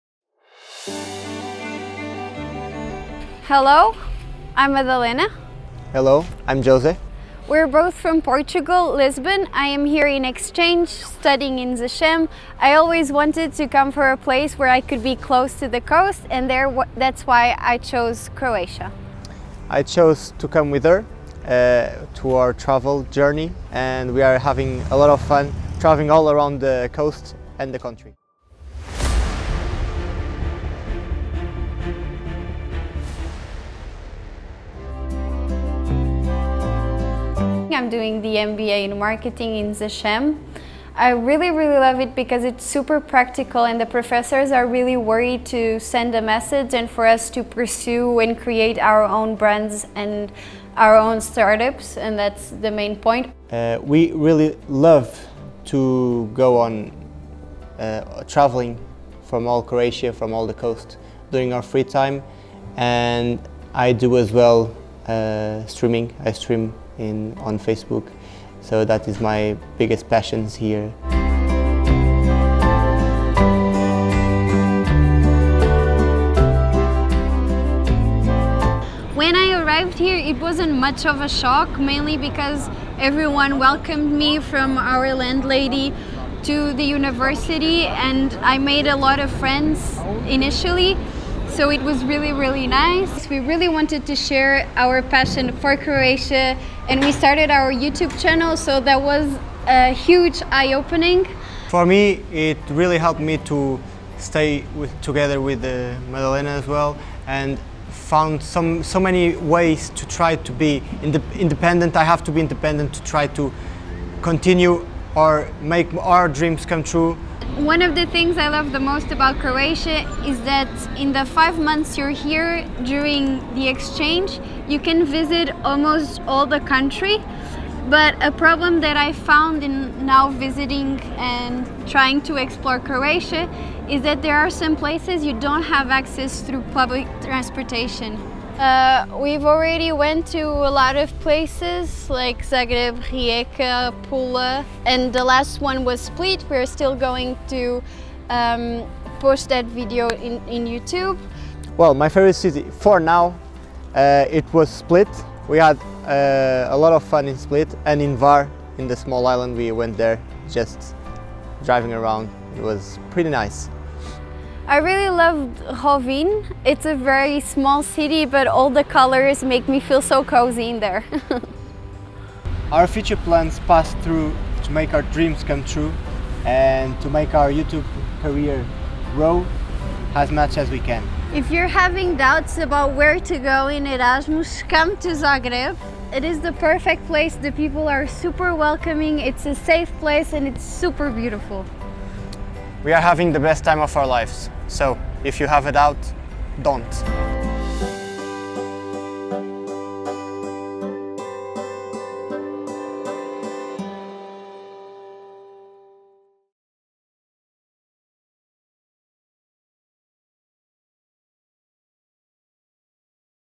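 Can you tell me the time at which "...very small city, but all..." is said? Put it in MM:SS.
02:46.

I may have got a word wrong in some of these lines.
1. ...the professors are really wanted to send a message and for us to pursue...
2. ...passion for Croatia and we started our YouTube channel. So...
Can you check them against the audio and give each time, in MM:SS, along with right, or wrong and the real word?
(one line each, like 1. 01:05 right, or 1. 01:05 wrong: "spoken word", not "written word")
1. 00:43 wrong: "worried", not "wanted"
2. 01:35 right.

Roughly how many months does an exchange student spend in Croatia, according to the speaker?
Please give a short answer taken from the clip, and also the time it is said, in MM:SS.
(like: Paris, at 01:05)
5, at 02:01.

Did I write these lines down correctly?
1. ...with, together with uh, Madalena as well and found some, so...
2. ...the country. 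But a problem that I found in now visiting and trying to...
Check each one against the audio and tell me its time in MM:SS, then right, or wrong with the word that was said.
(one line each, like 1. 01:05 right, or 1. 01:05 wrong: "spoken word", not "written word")
1. 01:44 right
2. 02:06 right.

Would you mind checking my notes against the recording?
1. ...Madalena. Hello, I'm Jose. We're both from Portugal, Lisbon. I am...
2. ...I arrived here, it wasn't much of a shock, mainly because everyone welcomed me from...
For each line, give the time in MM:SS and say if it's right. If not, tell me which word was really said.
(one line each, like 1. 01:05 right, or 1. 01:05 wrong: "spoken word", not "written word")
1. 00:04 right
2. 01:19 right.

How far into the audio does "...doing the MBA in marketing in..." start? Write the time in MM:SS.
00:37.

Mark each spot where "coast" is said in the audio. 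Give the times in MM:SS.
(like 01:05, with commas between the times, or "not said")
00:15, 00:26, 01:00.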